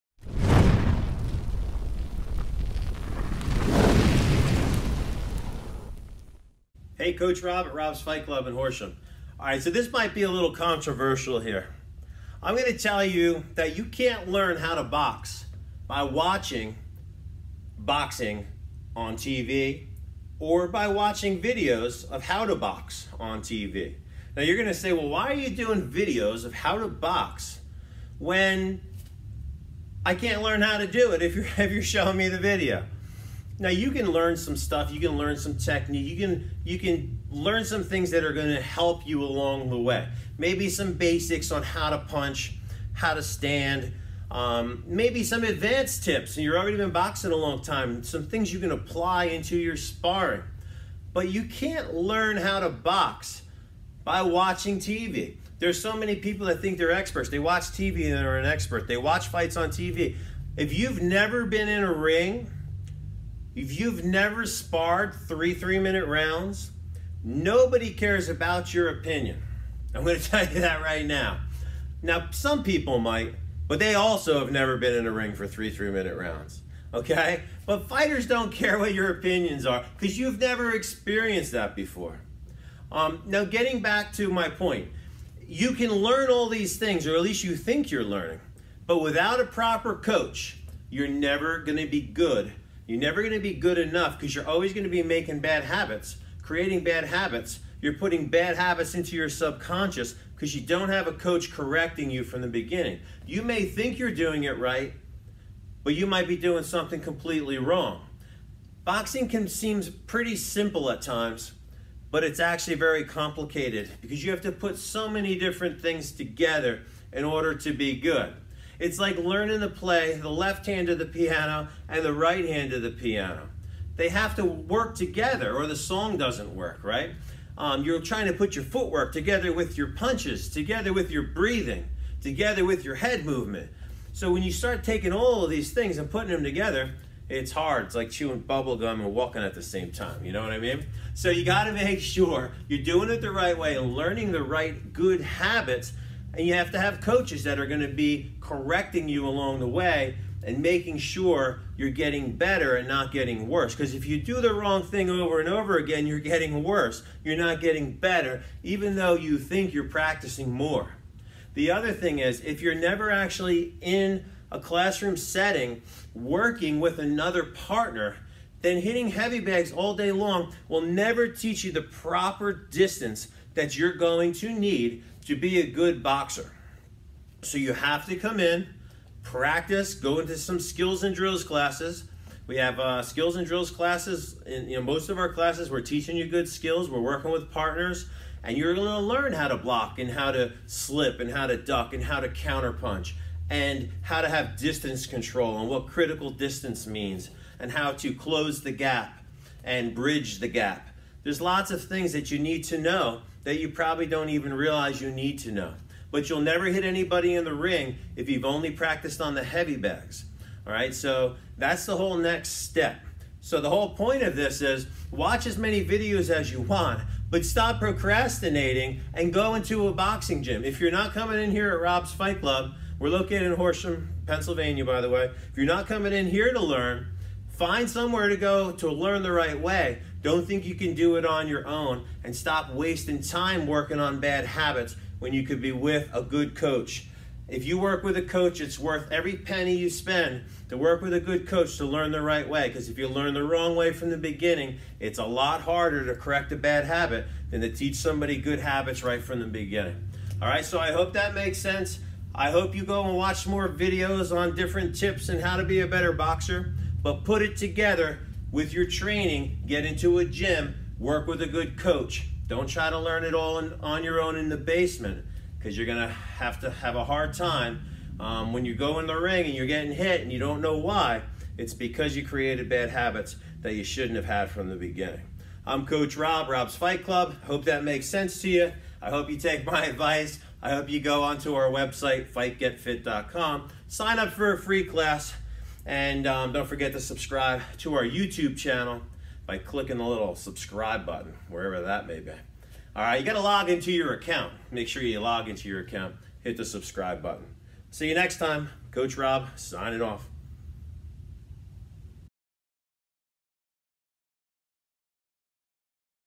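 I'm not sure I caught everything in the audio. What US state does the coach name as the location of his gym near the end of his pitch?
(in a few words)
Pennsylvania.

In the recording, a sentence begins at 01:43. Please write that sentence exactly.
You may think you're doing it right, but you might be doing something completely wrong.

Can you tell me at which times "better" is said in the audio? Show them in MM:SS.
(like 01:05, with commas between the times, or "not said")
02:32, 02:37, 04:15.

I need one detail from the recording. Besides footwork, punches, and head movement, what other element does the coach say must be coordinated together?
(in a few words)
Breathing.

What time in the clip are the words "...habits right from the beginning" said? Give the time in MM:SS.
04:08.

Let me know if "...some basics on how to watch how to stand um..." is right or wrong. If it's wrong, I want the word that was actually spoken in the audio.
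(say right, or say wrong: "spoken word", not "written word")
wrong: "punch", not "watch".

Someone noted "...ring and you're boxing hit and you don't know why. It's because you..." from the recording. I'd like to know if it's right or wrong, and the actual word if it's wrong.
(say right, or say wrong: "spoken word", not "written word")
wrong: "getting", not "boxing".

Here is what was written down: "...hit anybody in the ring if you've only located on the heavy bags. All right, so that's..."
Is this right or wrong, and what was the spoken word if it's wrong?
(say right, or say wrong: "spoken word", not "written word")
wrong: "practiced", not "located".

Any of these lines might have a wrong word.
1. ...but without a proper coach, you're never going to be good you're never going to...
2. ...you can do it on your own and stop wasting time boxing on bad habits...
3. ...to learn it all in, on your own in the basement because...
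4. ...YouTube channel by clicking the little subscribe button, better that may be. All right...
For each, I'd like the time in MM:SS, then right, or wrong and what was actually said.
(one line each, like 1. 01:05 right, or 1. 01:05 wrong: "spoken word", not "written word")
1. 01:28 right
2. 03:50 wrong: "working", not "boxing"
3. 04:22 right
4. 04:48 wrong: "wherever", not "better".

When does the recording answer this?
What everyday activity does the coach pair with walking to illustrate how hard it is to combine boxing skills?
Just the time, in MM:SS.
02:18.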